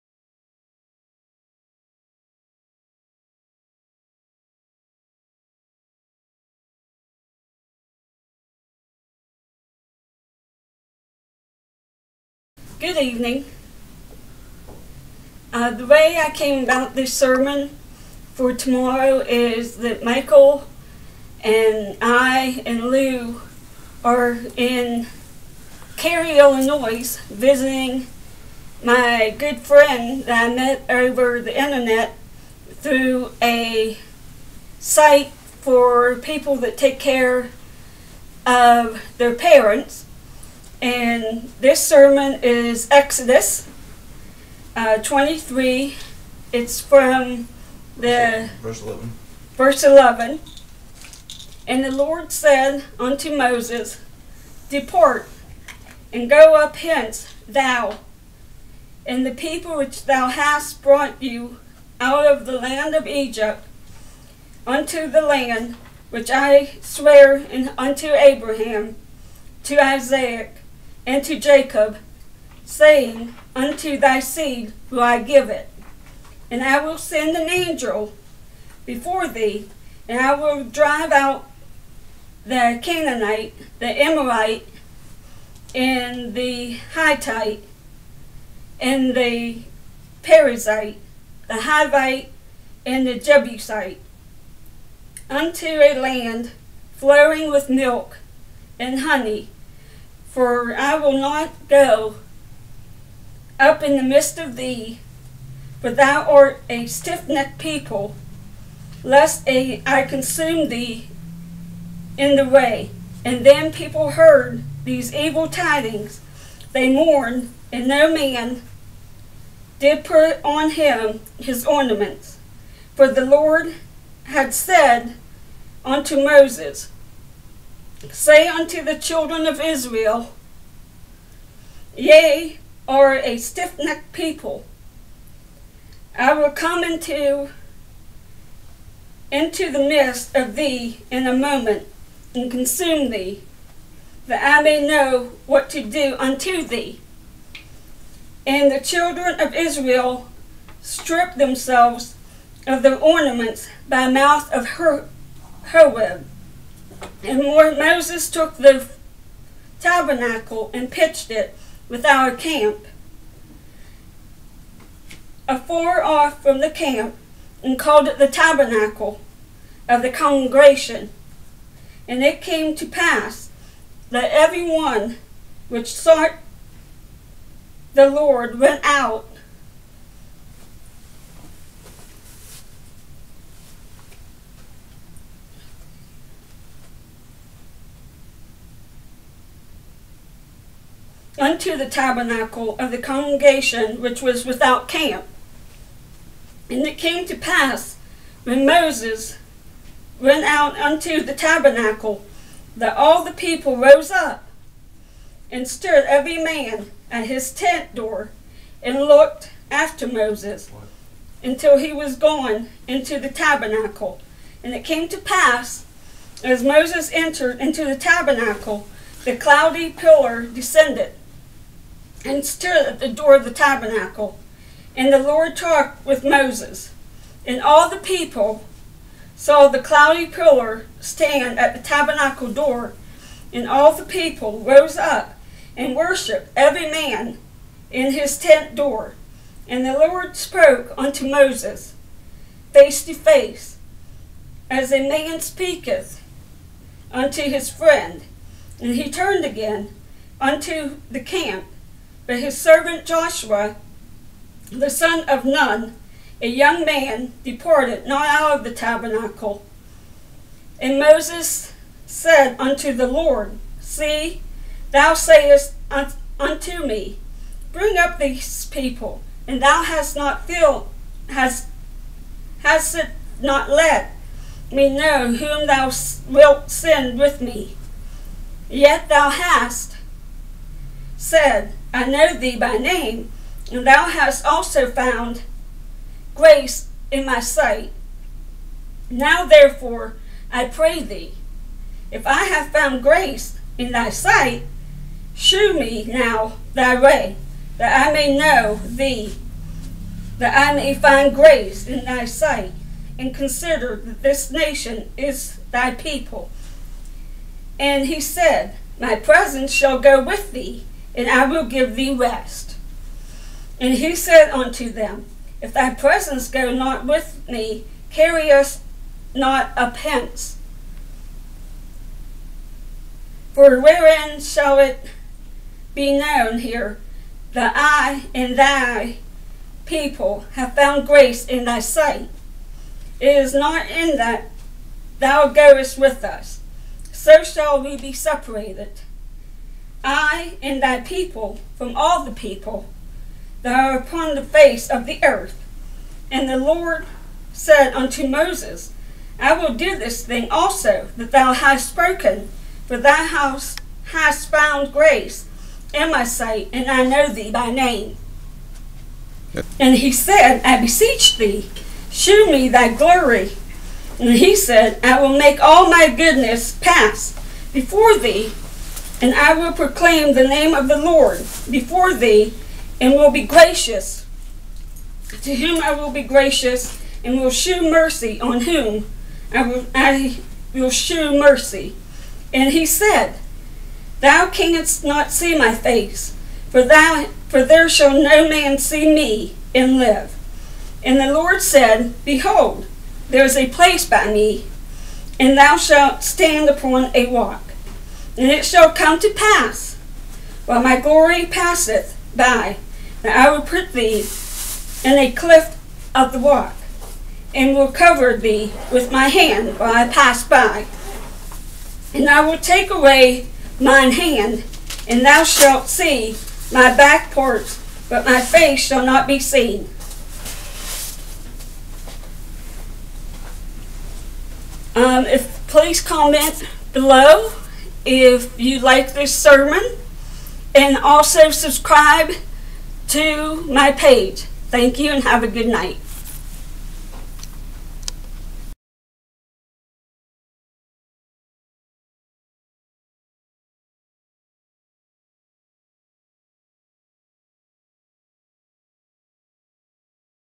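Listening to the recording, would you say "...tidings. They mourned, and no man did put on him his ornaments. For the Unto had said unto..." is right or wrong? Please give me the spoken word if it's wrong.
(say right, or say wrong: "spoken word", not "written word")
wrong: "Lord", not "Unto".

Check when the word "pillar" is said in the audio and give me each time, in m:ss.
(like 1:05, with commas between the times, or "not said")
3:39, 3:50.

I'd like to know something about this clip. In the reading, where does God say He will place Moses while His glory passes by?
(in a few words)
A cliff of the rock.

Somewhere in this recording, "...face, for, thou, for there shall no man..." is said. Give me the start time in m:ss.
6:25.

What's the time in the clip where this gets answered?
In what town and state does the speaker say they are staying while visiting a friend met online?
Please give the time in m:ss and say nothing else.
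0:25.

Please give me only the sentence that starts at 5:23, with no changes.
For wherein shall it be known here that I and thy people have found grace in thy sight?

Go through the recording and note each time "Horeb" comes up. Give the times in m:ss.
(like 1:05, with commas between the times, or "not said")
2:35.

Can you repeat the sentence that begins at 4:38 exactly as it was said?
Yet thou hast said, I know thee by name, and thou hast also found grace in my sight.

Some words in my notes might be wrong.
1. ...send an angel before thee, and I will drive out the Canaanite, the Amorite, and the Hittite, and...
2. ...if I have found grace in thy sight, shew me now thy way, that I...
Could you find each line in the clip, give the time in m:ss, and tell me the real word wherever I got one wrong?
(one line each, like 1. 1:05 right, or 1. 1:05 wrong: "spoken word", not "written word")
1. 1:16 right
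2. 4:52 right.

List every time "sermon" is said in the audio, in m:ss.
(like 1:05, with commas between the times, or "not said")
0:17, 0:41, 7:09.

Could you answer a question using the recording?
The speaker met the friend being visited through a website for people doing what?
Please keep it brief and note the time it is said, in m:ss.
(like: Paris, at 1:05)
Take care of their parents, at 0:36.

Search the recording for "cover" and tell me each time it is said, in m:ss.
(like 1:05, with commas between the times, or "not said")
6:47.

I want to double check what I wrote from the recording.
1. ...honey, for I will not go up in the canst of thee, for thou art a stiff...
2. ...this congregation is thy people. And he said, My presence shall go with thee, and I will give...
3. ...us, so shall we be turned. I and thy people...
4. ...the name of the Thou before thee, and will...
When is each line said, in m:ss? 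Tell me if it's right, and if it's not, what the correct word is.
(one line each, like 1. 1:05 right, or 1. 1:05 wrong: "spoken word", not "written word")
1. 1:39 wrong: "midst", not "canst"
2. 5:04 wrong: "nation", not "congregation"
3. 5:36 wrong: "separated", not "turned"
4. 6:10 wrong: "Lord", not "Thou".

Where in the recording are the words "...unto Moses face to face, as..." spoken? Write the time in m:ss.
4:00.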